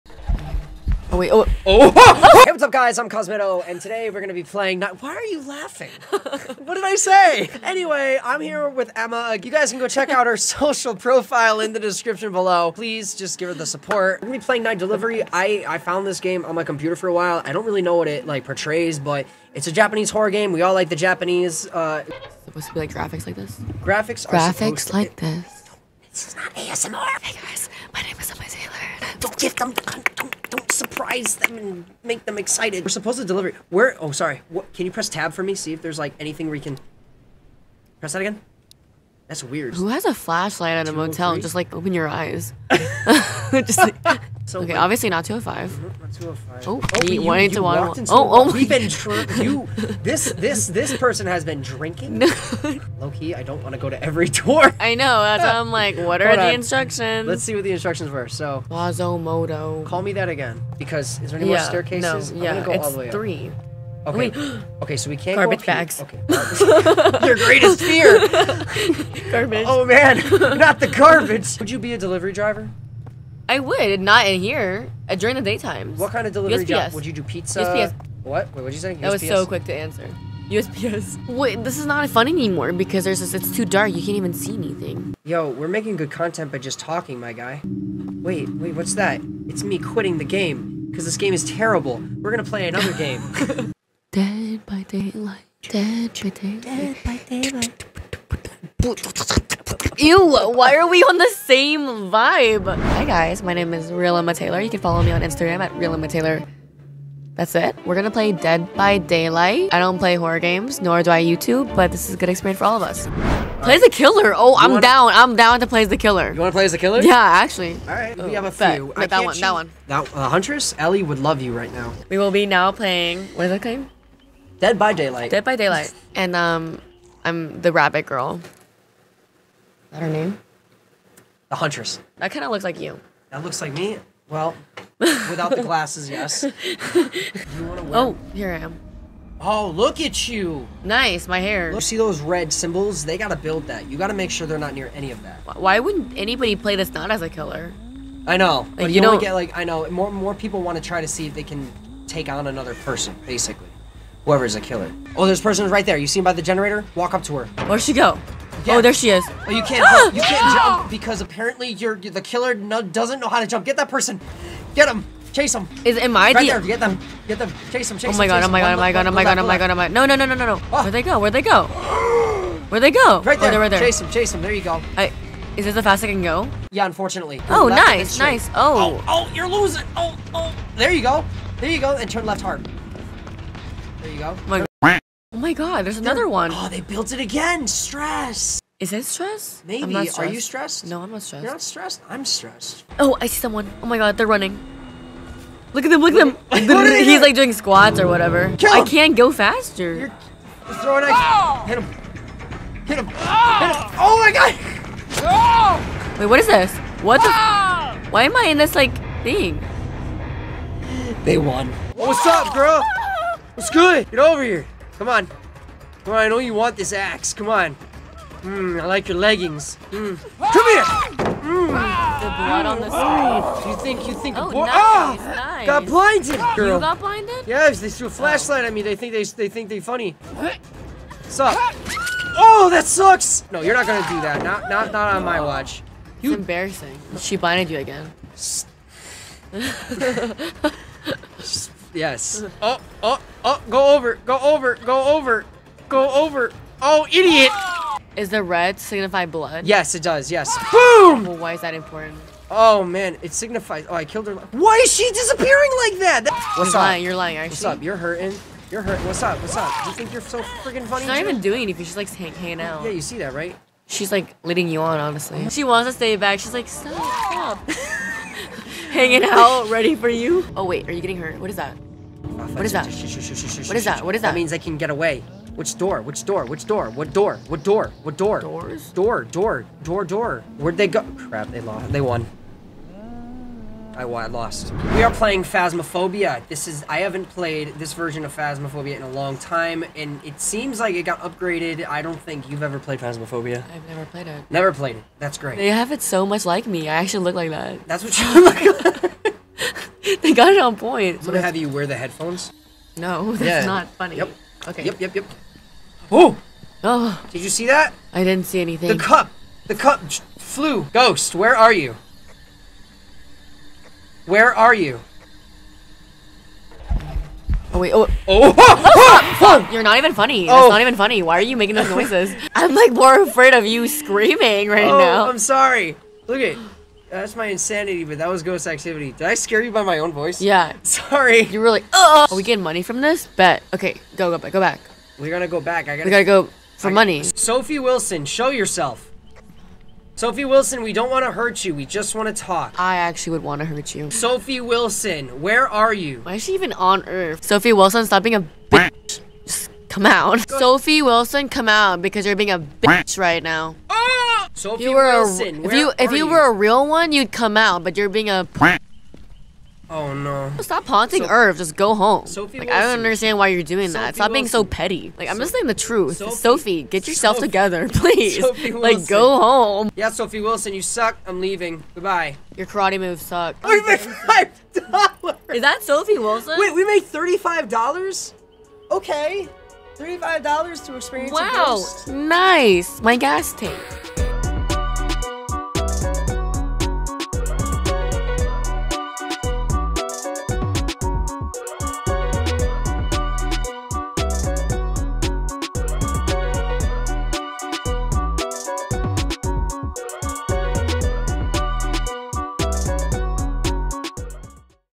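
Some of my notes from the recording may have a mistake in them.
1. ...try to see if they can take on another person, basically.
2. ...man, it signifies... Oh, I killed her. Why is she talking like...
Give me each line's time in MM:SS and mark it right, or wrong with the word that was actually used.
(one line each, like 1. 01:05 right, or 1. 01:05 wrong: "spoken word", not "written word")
1. 02:30 right
2. 04:12 wrong: "disappearing", not "talking".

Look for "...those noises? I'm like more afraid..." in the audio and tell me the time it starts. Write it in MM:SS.
05:21.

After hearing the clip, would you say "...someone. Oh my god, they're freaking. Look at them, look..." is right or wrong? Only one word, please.
wrong.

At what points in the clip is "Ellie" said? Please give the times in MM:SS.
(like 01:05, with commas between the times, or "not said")
02:00.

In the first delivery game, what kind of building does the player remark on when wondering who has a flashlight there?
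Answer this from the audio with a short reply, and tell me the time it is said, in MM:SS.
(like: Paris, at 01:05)
motel, at 00:40.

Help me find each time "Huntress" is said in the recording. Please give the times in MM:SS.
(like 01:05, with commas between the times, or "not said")
02:00, 02:11.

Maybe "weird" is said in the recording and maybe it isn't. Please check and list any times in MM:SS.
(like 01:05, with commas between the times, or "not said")
00:39.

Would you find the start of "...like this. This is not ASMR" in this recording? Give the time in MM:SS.
00:24.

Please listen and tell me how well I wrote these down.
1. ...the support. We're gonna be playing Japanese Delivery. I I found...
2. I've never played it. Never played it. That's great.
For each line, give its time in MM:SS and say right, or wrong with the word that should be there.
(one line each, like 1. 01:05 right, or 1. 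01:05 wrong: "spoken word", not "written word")
1. 00:13 wrong: "Night", not "Japanese"
2. 04:53 right.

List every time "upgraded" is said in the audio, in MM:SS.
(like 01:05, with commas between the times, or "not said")
04:51.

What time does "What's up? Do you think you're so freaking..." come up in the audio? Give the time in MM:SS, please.
04:19.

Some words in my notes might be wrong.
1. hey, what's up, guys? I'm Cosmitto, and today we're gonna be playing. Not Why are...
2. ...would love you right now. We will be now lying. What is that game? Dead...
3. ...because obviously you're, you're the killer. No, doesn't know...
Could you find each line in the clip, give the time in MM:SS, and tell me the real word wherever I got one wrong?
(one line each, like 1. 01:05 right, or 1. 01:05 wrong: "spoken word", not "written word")
1. 00:02 right
2. 02:01 wrong: "playing", not "lying"
3. 02:40 wrong: "apparently", not "obviously".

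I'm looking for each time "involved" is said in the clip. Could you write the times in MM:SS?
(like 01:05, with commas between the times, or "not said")
not said.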